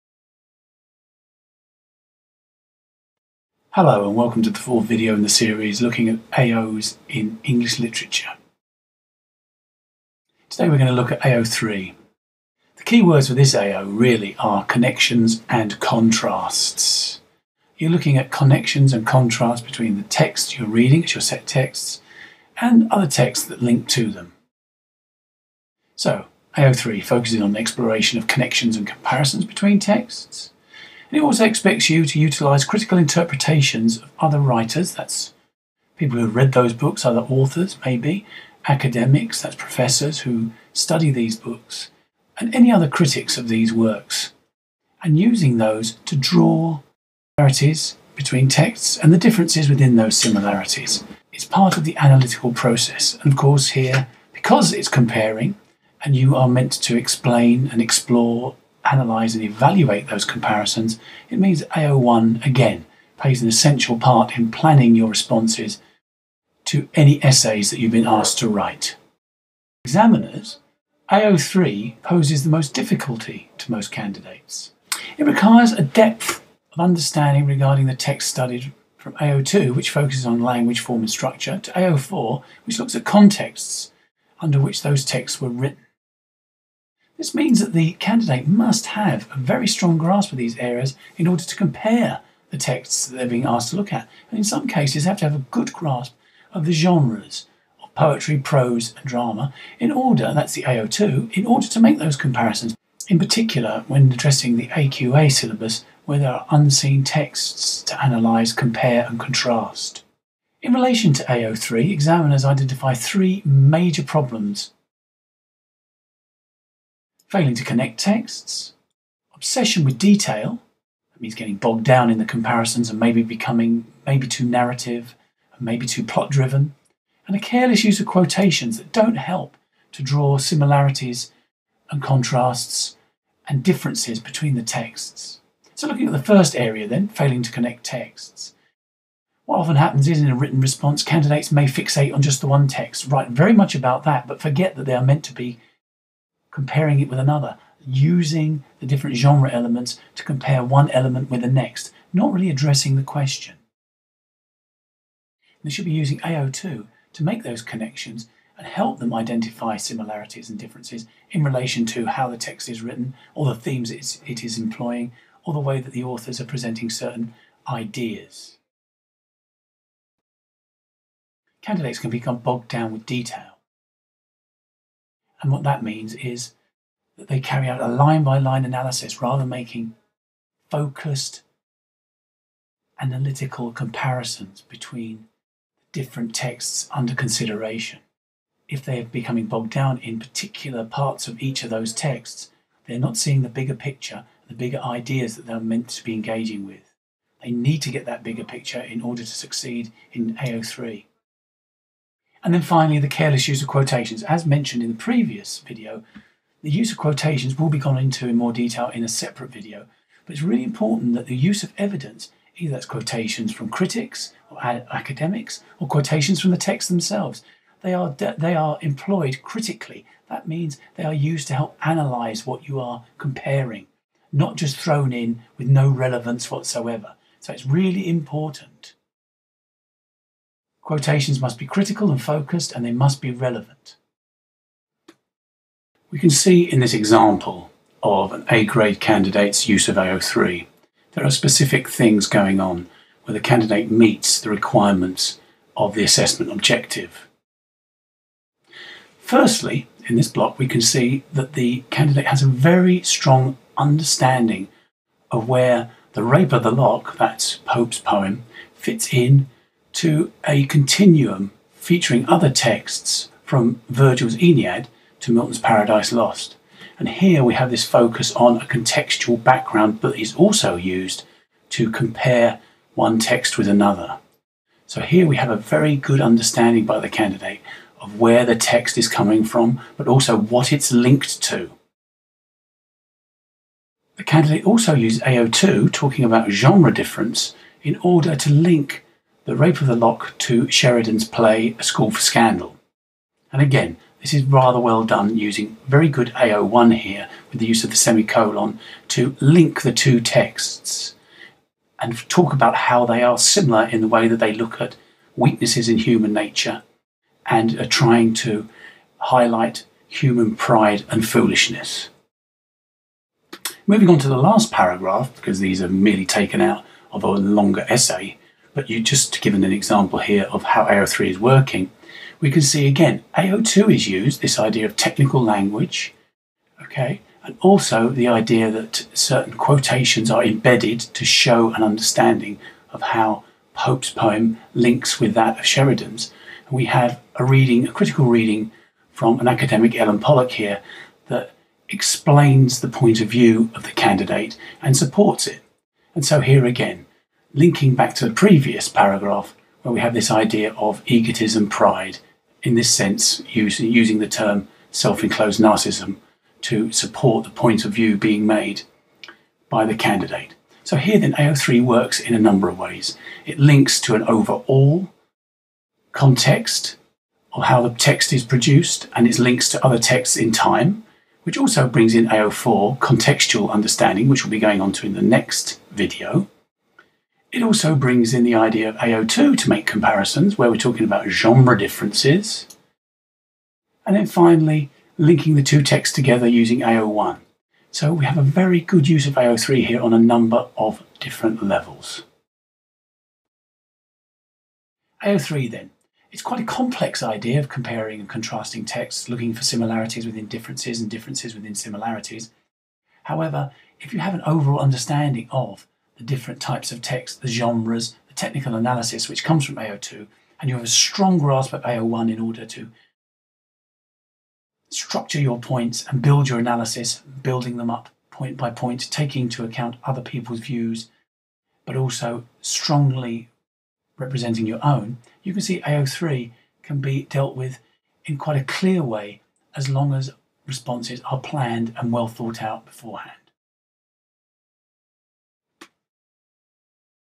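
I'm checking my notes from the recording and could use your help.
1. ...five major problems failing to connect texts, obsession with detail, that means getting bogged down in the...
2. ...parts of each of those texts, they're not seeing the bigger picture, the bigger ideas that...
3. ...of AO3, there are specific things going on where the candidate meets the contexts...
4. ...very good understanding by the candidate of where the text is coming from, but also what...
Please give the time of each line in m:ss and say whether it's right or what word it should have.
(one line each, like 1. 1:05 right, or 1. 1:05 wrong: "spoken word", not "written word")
1. 1:52 wrong: "three", not "five"
2. 3:10 right
3. 3:59 wrong: "requirements", not "contexts"
4. 4:35 right.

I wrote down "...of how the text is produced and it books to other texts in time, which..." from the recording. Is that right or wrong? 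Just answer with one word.
wrong.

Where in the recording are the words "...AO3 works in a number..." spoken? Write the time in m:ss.
6:01.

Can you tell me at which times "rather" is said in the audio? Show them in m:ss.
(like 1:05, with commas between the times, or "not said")
2:59, 4:54.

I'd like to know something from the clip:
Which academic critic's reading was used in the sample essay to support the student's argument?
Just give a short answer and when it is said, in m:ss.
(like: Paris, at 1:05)
Ellen Pollak, at 5:39.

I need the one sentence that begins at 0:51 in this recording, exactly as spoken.
It's part of the analytical process.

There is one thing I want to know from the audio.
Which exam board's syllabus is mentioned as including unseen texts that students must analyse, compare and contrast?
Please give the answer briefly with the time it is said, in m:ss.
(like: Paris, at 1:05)
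AQA, at 1:44.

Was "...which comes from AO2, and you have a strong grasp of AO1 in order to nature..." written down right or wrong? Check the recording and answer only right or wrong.
wrong.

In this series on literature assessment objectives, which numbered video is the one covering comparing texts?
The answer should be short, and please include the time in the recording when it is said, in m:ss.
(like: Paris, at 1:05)
fourth, at 0:04.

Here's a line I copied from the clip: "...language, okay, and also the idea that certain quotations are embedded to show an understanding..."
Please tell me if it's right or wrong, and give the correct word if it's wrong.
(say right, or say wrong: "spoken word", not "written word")
right.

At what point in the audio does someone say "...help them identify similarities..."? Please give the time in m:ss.
2:38.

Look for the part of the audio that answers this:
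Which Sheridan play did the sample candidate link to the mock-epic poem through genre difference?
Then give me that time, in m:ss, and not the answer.
4:51.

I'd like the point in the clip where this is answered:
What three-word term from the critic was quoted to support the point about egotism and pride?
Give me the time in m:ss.
5:54.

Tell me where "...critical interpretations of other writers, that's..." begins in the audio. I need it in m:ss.
0:32.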